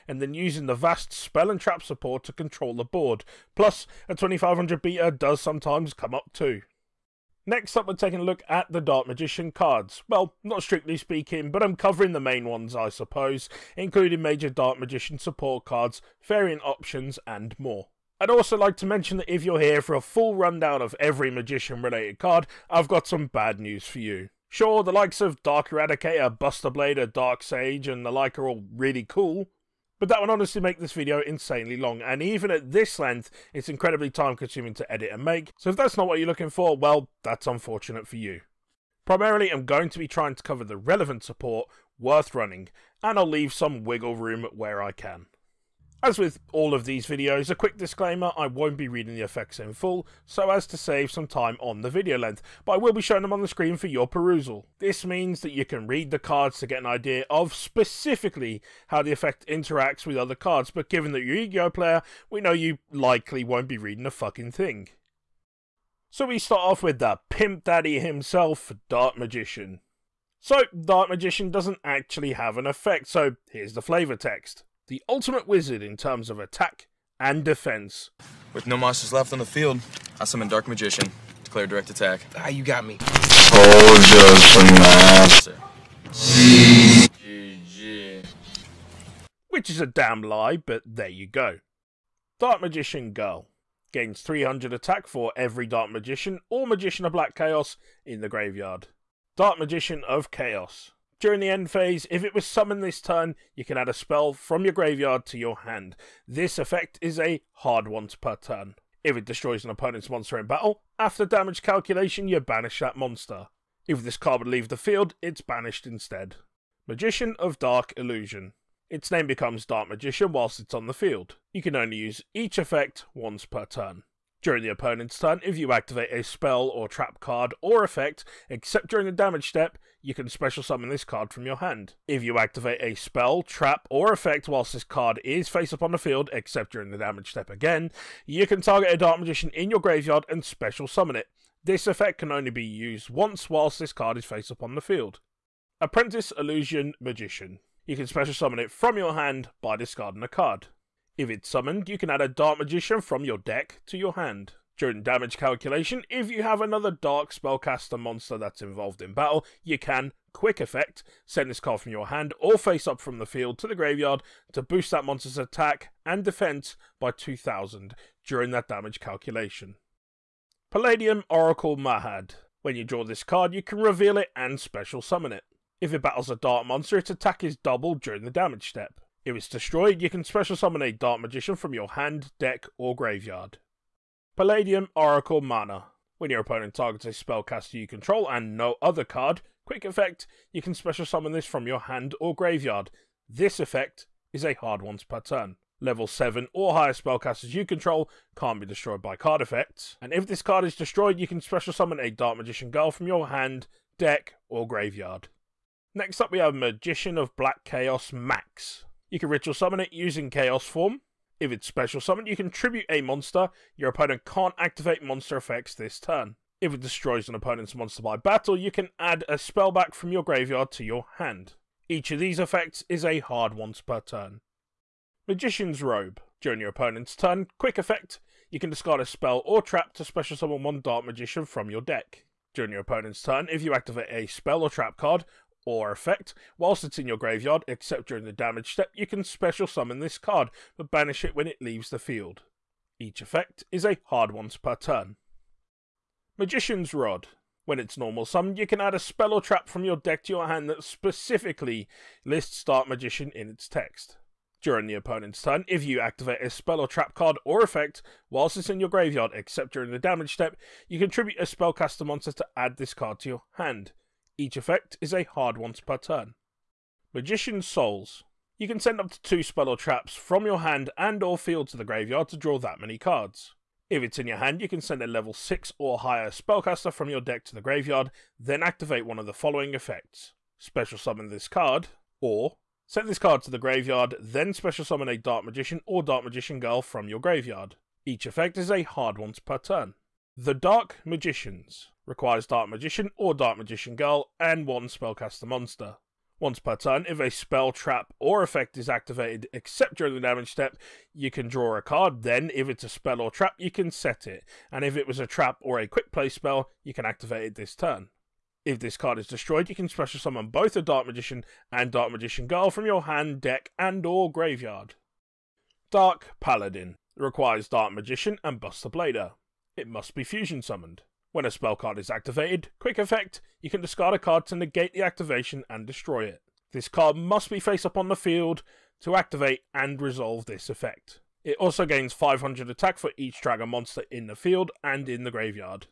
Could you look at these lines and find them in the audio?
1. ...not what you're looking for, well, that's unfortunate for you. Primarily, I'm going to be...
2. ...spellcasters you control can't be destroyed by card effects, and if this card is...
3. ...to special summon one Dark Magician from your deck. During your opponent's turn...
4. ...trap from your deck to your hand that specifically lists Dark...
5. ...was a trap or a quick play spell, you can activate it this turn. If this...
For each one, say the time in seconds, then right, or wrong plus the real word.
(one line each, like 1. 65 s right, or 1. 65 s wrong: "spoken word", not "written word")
1. 35 s right
2. 196 s right
3. 229 s right
4. 249 s right
5. 305 s right.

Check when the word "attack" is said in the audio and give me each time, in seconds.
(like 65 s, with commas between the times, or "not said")
76 s, 81 s, 94 s, 165 s, 177 s, 332 s.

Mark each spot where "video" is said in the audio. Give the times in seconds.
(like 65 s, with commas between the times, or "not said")
30 s, 47 s, 51 s.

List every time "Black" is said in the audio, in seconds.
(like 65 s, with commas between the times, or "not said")
97 s, 207 s.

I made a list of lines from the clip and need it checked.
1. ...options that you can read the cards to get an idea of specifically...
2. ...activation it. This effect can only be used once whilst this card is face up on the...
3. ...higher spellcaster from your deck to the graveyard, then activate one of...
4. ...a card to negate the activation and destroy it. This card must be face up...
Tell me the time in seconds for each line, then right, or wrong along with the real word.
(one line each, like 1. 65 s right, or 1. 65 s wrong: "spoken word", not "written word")
1. 55 s wrong: "means", not "options"
2. 140 s wrong: "summon", not "activation"
3. 275 s right
4. 324 s right.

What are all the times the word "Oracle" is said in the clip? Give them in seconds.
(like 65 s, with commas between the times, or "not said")
171 s, 184 s.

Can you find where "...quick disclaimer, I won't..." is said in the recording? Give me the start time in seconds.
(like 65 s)
47 s.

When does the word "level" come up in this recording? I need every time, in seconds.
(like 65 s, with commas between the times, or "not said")
195 s, 275 s.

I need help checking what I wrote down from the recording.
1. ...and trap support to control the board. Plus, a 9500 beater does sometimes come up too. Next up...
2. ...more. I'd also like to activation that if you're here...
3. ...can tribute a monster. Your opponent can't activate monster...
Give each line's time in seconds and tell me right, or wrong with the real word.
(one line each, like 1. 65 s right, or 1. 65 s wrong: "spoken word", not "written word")
1. 1 s wrong: "2500", not "9500"
2. 17 s wrong: "mention", not "activation"
3. 212 s right.